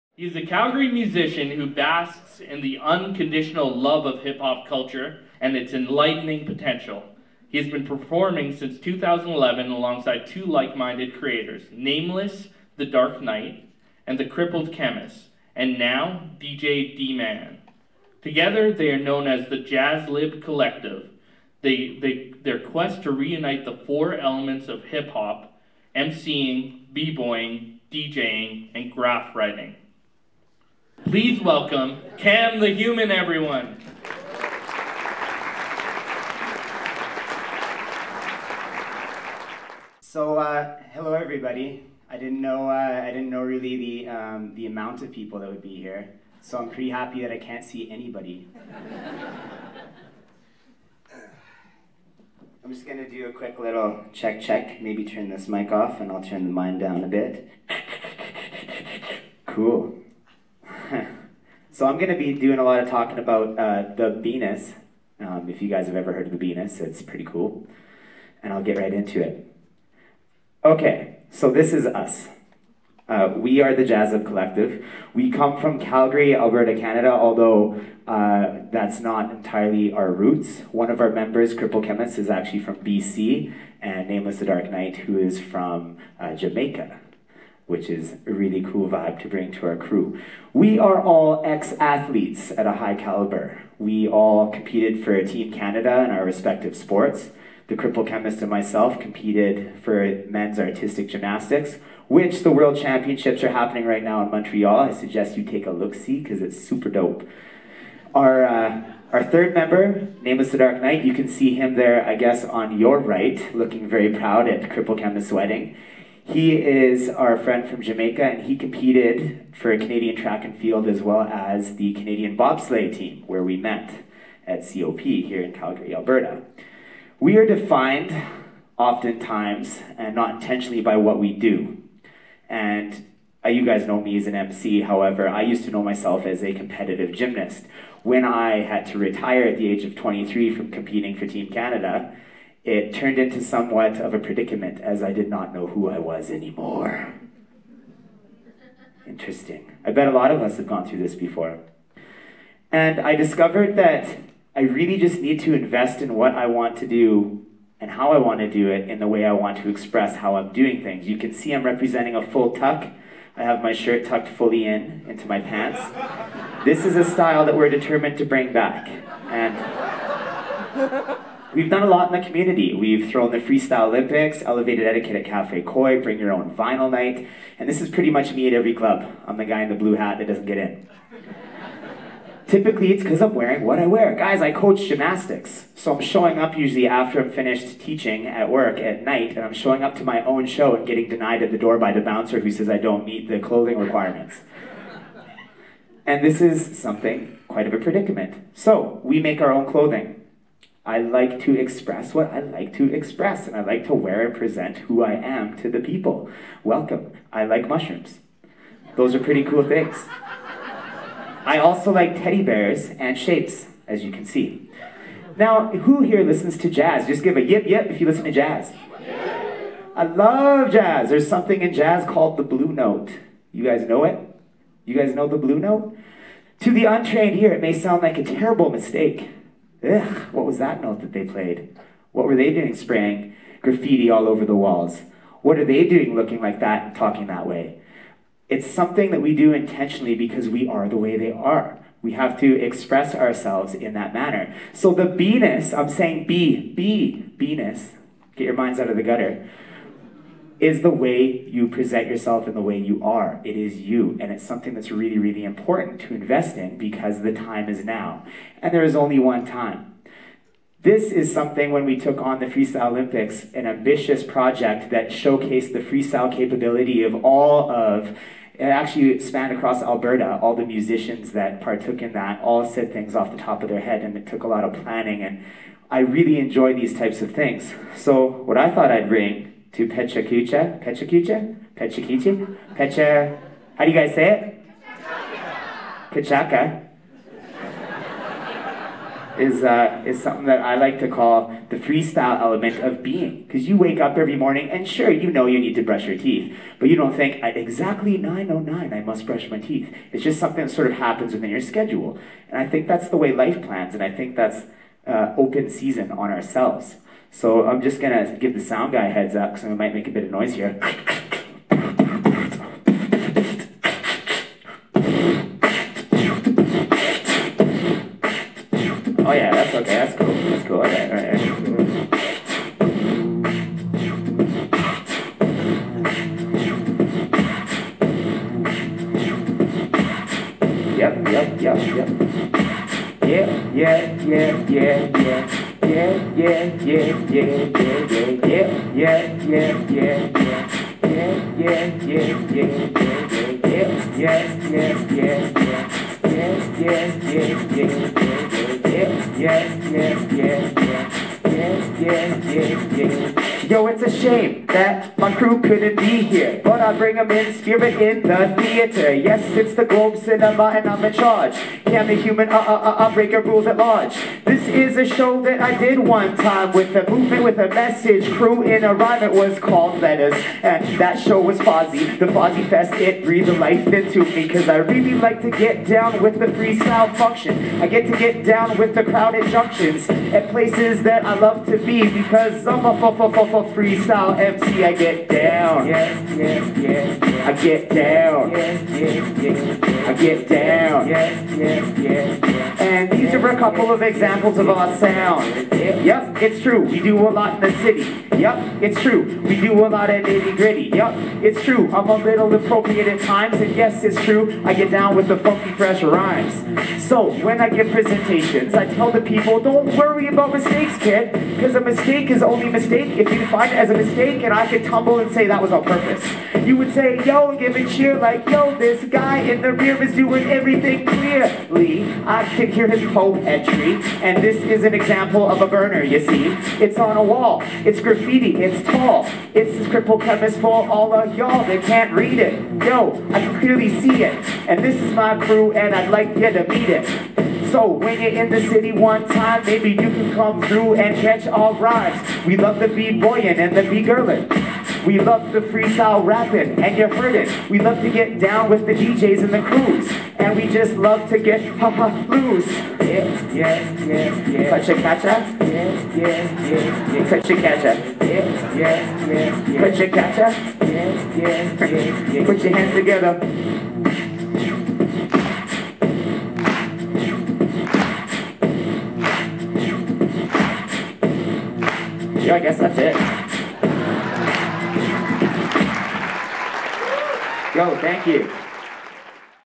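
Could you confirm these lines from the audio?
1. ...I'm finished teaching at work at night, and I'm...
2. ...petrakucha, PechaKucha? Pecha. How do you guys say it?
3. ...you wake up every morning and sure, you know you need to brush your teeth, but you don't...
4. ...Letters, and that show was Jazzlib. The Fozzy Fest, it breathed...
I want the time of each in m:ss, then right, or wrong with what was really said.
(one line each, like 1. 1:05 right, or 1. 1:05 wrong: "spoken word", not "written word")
1. 3:07 right
2. 4:40 right
3. 4:53 right
4. 6:10 wrong: "Fozzy", not "Jazzlib".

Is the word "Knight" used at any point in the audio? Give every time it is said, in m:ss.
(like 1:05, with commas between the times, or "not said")
0:13, 1:24, 1:50.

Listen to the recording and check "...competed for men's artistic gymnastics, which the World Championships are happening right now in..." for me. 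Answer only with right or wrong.
right.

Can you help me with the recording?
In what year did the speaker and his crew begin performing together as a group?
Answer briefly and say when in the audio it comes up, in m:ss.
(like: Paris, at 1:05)
2011, at 0:08.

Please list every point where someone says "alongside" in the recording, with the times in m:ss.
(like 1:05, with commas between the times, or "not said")
0:09.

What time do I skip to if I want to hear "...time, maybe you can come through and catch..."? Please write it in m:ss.
7:19.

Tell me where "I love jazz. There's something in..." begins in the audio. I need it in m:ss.
3:39.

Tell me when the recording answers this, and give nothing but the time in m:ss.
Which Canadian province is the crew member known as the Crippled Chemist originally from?
1:22.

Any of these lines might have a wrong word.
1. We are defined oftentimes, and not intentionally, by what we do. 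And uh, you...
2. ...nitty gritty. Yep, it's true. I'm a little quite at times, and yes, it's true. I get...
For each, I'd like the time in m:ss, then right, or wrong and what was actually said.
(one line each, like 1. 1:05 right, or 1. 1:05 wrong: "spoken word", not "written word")
1. 2:07 right
2. 6:40 wrong: "appropriate", not "quite".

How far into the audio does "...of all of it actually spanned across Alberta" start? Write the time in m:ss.
4:27.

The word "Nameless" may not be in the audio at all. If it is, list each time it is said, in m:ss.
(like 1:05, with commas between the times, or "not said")
0:11, 1:24, 1:50.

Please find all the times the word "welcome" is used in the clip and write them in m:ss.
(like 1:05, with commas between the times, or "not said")
0:31, 3:26.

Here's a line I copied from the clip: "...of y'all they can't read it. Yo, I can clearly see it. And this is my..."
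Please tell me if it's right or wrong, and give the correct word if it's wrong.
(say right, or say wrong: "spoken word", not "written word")
right.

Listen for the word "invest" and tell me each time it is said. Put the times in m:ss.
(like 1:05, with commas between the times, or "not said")
2:35, 4:16.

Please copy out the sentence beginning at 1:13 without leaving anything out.
Uh, we are the Jazzlib Collective.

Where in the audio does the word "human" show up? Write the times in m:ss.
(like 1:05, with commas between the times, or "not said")
0:32, 6:02.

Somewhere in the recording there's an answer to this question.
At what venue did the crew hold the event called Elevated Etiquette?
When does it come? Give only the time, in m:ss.
2:55.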